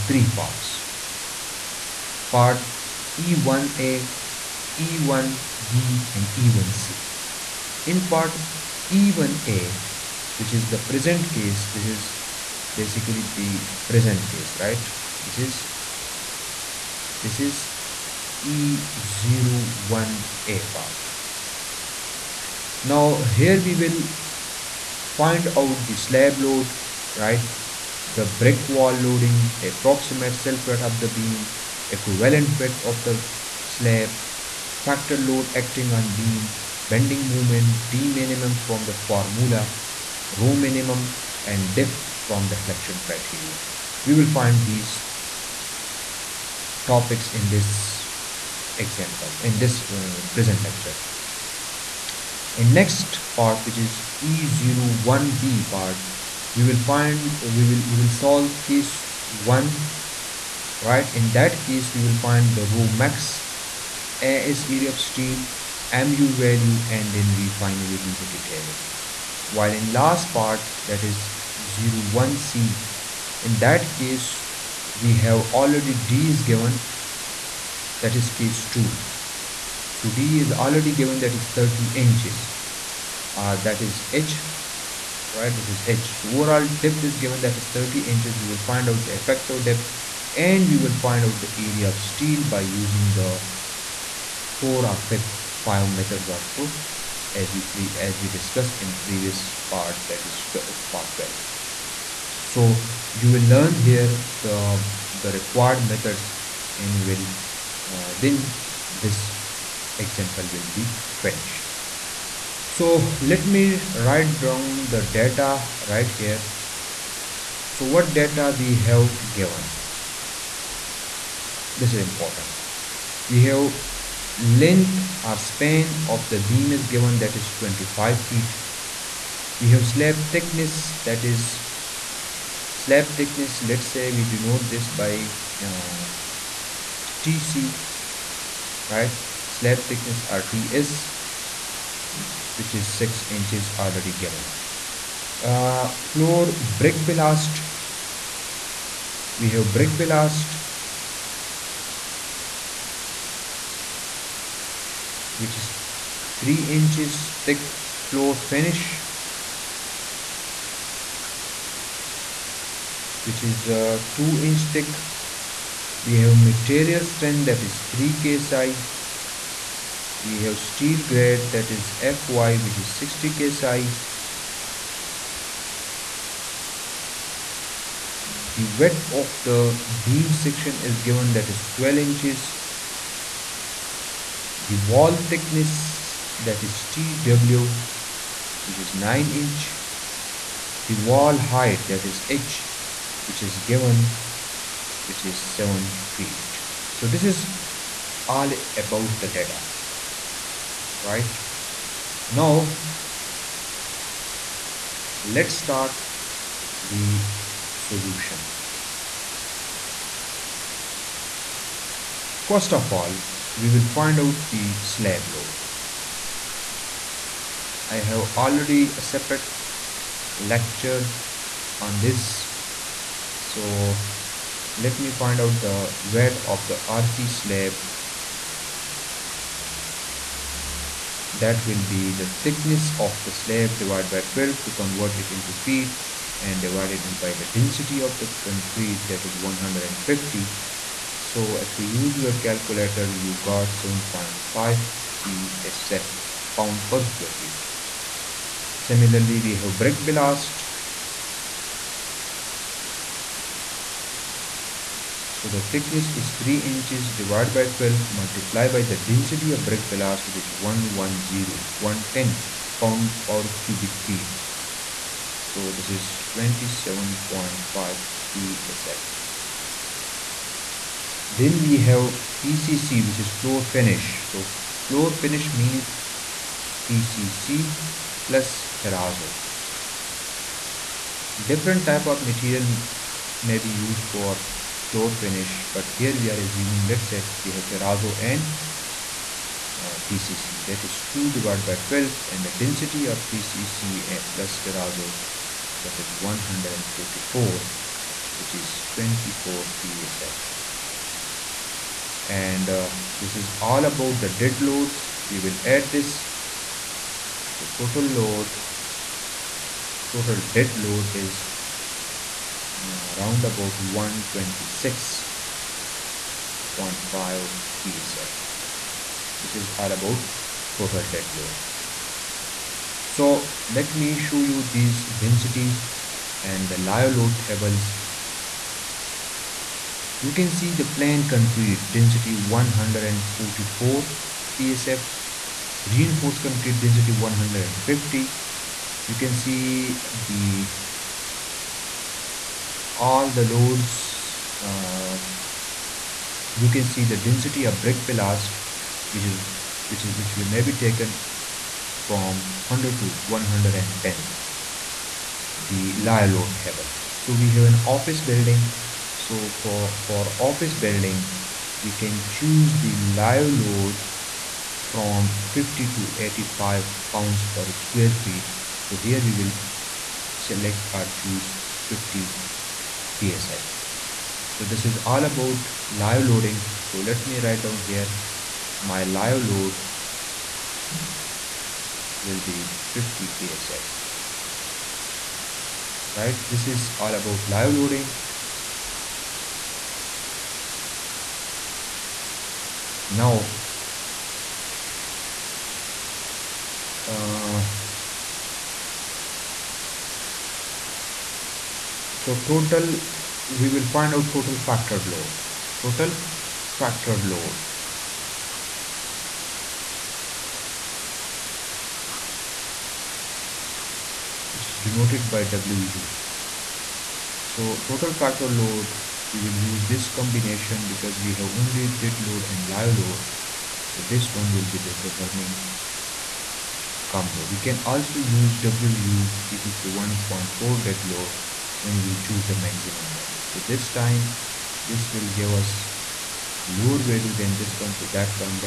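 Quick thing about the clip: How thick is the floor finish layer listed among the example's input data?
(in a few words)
2 inch.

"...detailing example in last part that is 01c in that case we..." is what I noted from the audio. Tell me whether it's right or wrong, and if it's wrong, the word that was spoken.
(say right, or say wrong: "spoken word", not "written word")
wrong: "while", not "example".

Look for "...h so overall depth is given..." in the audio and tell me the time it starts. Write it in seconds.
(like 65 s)
85 s.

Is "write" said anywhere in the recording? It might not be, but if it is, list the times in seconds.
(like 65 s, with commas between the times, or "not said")
114 s, 377 s.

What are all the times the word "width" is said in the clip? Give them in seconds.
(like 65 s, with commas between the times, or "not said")
32 s, 178 s.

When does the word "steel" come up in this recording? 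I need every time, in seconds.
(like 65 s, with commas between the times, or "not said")
65 s, 92 s, 170 s.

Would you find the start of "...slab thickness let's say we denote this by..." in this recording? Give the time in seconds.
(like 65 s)
132 s.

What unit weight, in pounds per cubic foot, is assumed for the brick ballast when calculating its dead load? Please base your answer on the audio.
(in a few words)
110.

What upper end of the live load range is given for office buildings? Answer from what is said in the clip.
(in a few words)
85 psf.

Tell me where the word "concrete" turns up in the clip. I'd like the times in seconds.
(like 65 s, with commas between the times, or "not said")
238 s, 331 s, 336 s.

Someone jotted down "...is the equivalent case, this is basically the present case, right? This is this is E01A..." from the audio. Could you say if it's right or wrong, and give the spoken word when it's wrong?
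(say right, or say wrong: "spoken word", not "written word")
wrong: "present", not "equivalent".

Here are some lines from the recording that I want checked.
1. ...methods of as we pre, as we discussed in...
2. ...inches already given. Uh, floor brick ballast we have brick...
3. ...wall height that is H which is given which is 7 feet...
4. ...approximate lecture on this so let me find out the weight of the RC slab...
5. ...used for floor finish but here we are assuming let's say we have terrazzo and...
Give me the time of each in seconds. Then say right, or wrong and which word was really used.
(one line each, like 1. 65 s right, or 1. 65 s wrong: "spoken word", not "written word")
1. 95 s right
2. 143 s right
3. 190 s right
4. 219 s wrong: "separate", not "approximate"
5. 283 s right.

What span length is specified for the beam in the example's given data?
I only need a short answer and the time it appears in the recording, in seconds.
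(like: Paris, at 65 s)
25 feet, at 127 s.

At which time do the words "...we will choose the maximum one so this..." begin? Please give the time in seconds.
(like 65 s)
432 s.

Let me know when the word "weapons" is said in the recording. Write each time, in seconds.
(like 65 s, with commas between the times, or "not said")
not said.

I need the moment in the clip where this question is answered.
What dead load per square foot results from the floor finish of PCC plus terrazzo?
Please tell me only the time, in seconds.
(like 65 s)
298 s.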